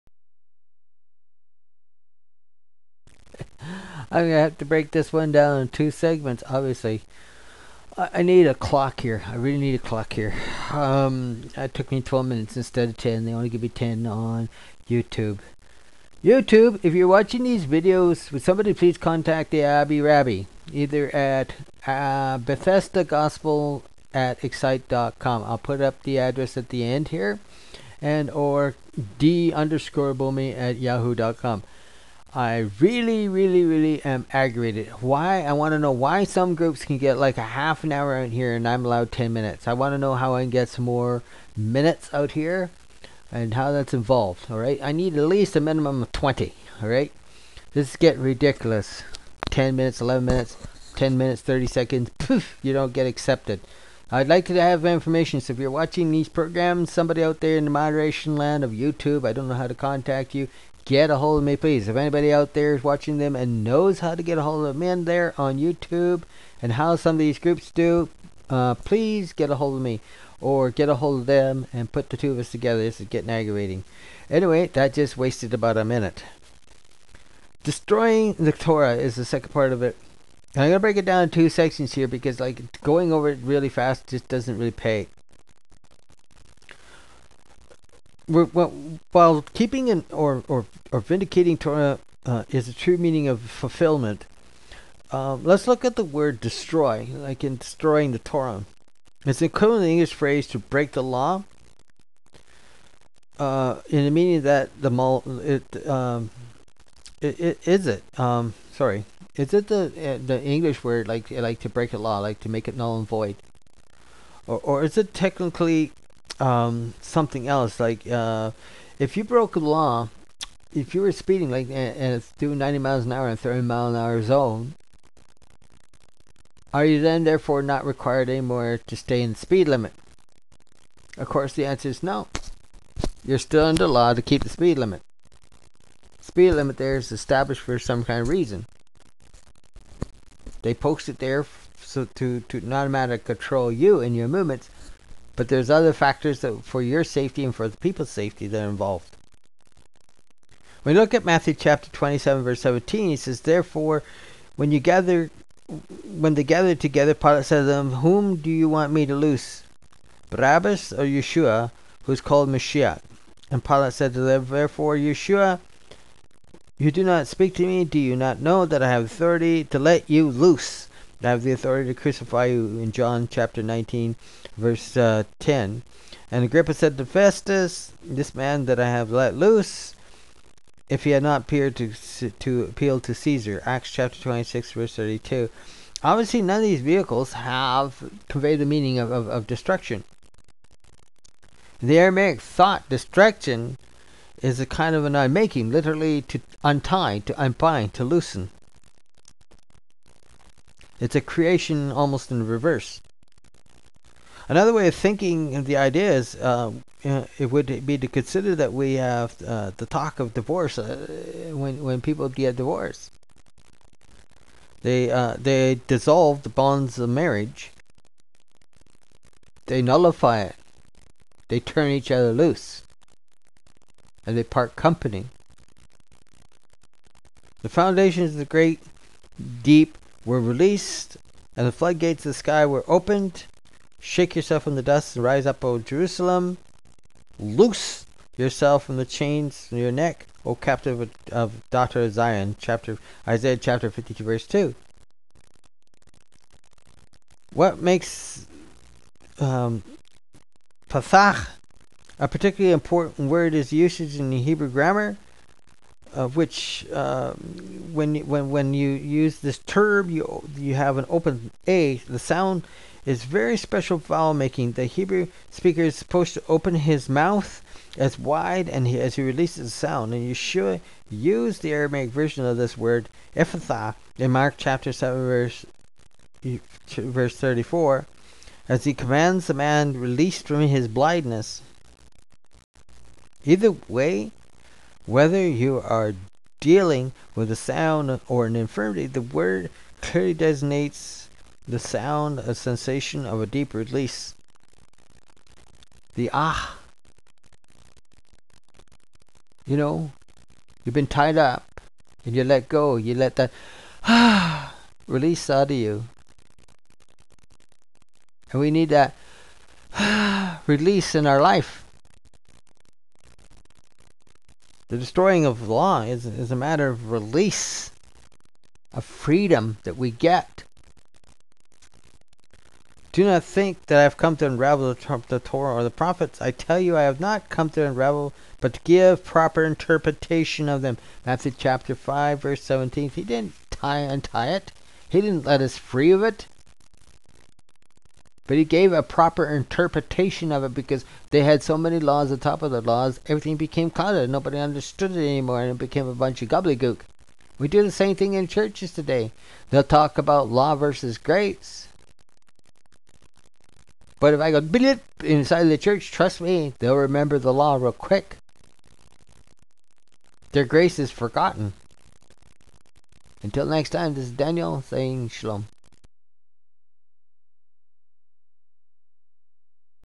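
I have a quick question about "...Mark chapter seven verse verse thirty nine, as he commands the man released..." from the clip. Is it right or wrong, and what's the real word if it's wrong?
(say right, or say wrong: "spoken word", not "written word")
wrong: "four", not "nine".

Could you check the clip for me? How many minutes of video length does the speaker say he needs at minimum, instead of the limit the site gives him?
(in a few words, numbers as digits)
20.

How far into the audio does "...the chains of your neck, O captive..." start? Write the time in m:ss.
3:58.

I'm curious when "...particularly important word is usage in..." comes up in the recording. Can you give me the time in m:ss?
4:12.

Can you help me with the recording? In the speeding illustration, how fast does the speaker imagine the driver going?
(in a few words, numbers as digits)
90 miles an hour.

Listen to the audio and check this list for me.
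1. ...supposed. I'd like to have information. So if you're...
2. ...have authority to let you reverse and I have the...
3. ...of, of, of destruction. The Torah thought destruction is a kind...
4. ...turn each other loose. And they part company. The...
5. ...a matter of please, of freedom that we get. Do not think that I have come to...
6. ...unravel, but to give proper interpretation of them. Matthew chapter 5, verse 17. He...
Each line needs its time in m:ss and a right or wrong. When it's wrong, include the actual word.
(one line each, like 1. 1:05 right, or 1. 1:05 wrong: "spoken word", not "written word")
1. 0:53 wrong: "accepted", not "supposed"
2. 2:48 wrong: "loose", not "reverse"
3. 3:08 wrong: "Aramaic", not "Torah"
4. 3:41 right
5. 5:16 wrong: "release", not "please"
6. 5:27 right.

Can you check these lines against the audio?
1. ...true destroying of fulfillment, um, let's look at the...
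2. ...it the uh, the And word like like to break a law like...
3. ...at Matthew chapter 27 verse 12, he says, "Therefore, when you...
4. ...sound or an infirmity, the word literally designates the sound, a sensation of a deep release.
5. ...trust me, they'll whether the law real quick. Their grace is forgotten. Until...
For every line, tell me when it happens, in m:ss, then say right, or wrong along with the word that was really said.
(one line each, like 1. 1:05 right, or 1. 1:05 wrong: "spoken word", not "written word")
1. 1:32 wrong: "meaning", not "destroying"
2. 1:49 wrong: "English", not "And"
3. 2:31 wrong: "17", not "12"
4. 4:47 wrong: "clearly", not "literally"
5. 5:56 wrong: "remember", not "whether".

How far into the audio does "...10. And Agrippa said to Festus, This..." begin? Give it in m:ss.
2:55.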